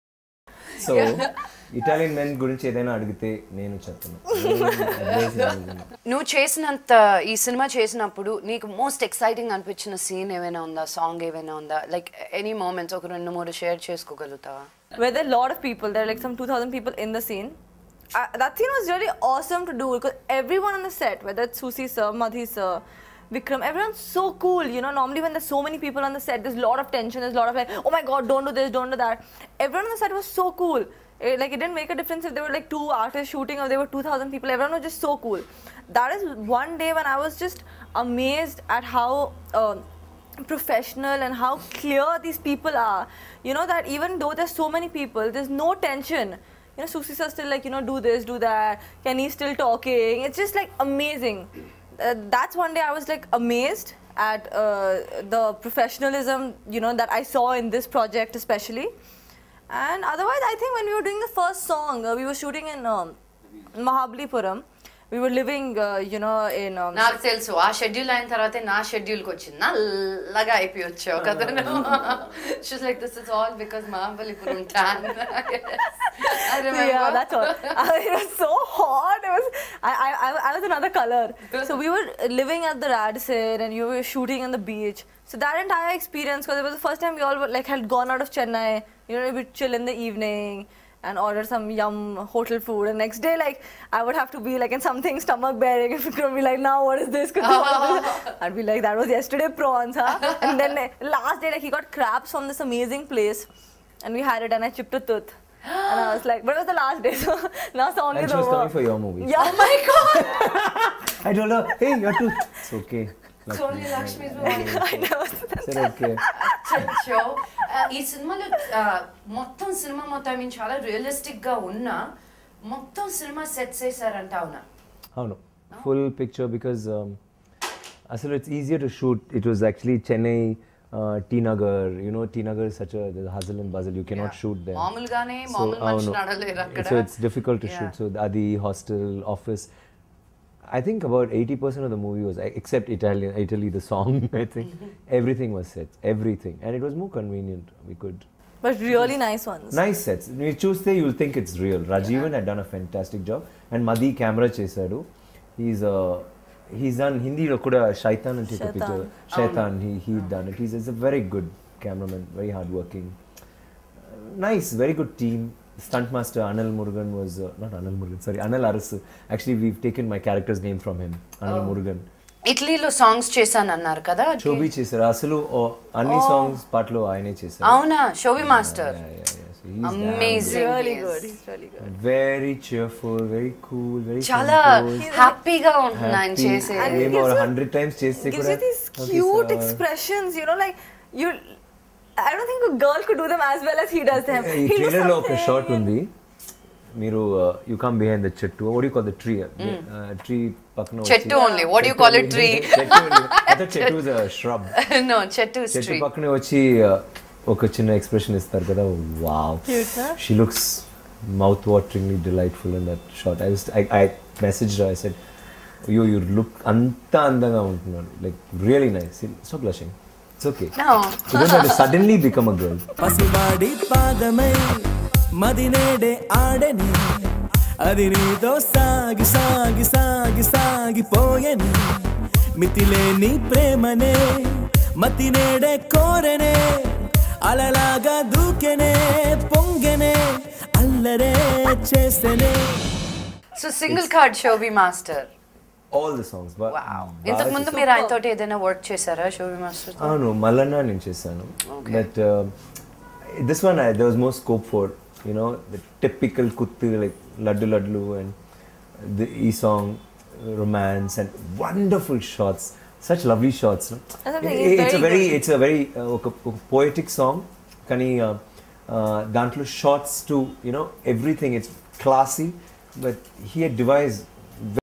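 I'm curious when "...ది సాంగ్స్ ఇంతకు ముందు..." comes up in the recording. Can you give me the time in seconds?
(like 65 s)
246 s.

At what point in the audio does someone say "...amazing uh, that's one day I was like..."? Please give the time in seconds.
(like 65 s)
50 s.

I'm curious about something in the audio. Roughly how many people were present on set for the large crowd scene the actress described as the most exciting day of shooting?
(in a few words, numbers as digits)
2000.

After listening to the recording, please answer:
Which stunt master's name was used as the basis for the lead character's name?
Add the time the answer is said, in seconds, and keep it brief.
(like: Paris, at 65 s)
Anil Arasu, at 168 s.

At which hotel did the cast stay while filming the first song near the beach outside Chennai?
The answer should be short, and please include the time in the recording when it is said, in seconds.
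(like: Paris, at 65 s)
Radisson, at 82 s.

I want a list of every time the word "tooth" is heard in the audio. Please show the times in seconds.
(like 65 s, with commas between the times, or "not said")
104 s, 112 s.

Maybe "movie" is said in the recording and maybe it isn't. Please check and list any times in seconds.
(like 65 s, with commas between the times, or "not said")
108 s, 114 s, 141 s.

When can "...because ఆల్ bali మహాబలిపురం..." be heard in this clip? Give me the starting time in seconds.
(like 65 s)
73 s.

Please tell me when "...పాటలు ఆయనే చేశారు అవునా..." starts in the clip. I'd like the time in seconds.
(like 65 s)
176 s.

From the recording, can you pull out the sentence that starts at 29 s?
Everyone on the set was so cool.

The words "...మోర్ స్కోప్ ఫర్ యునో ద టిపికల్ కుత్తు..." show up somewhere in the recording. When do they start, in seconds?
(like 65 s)
254 s.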